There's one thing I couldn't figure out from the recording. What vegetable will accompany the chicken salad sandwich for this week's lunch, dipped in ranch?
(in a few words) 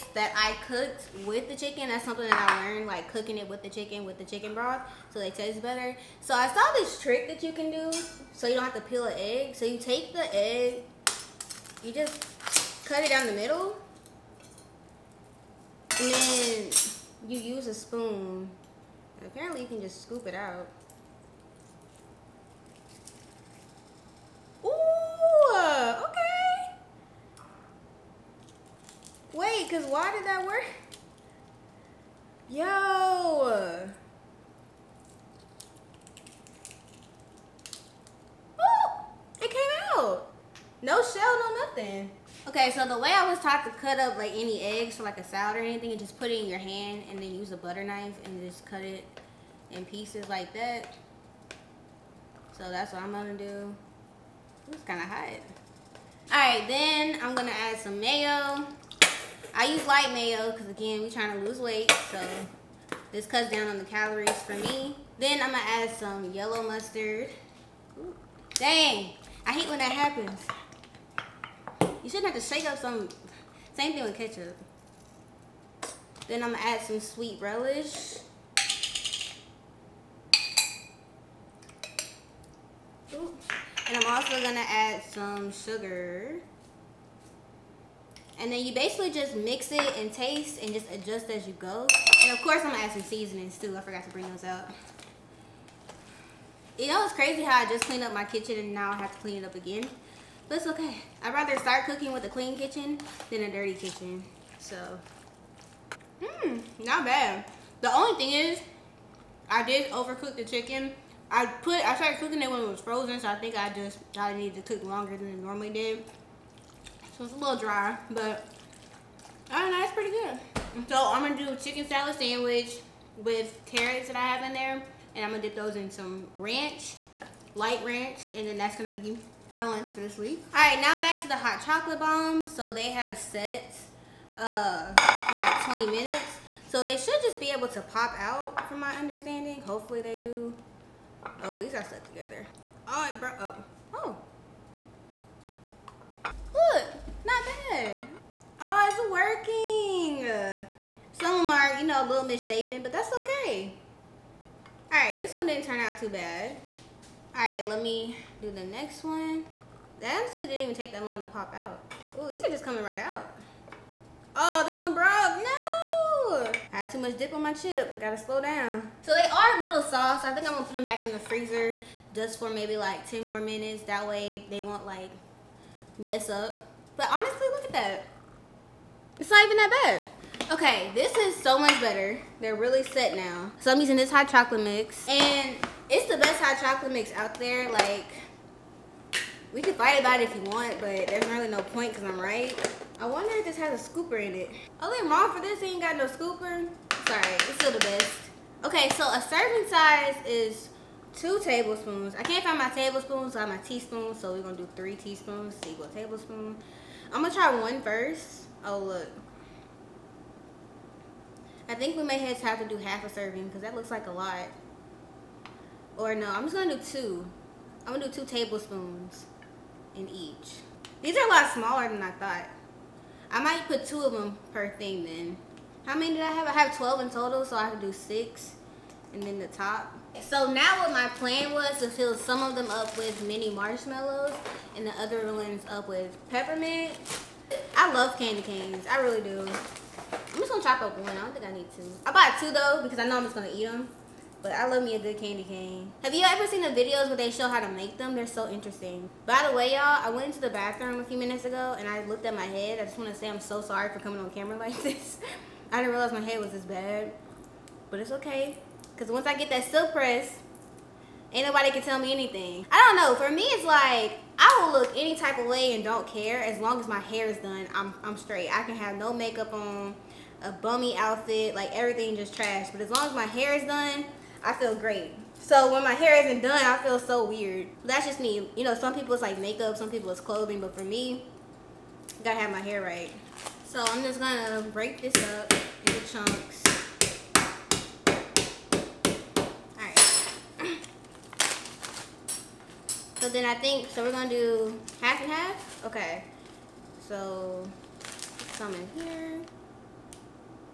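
carrots.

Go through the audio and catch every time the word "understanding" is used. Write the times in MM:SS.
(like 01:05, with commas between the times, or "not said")
02:18.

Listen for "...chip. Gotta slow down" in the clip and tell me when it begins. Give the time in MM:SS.
02:47.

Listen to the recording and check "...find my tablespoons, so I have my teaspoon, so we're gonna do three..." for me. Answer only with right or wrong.
right.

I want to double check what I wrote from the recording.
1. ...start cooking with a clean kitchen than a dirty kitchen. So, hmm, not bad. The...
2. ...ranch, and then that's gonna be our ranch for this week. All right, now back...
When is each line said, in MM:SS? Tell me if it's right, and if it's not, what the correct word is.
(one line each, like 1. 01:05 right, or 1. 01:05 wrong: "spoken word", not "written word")
1. 01:41 right
2. 02:07 wrong: "lunch", not "ranch".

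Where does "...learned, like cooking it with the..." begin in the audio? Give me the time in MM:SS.
00:02.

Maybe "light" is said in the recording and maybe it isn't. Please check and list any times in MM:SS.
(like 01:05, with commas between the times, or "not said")
00:59, 02:07.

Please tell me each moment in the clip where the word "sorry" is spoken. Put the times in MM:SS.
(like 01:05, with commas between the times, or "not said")
03:17, 04:13.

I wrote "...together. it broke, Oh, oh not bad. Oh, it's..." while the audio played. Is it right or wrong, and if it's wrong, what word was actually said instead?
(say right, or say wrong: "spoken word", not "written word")
right.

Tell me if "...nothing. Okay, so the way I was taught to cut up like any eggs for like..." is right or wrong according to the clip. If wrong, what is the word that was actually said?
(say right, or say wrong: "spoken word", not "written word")
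right.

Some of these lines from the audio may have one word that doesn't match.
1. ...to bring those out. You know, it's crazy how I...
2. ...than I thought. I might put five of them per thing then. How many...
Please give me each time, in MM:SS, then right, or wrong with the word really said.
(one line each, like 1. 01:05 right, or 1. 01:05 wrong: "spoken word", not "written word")
1. 01:34 right
2. 03:41 wrong: "two", not "five".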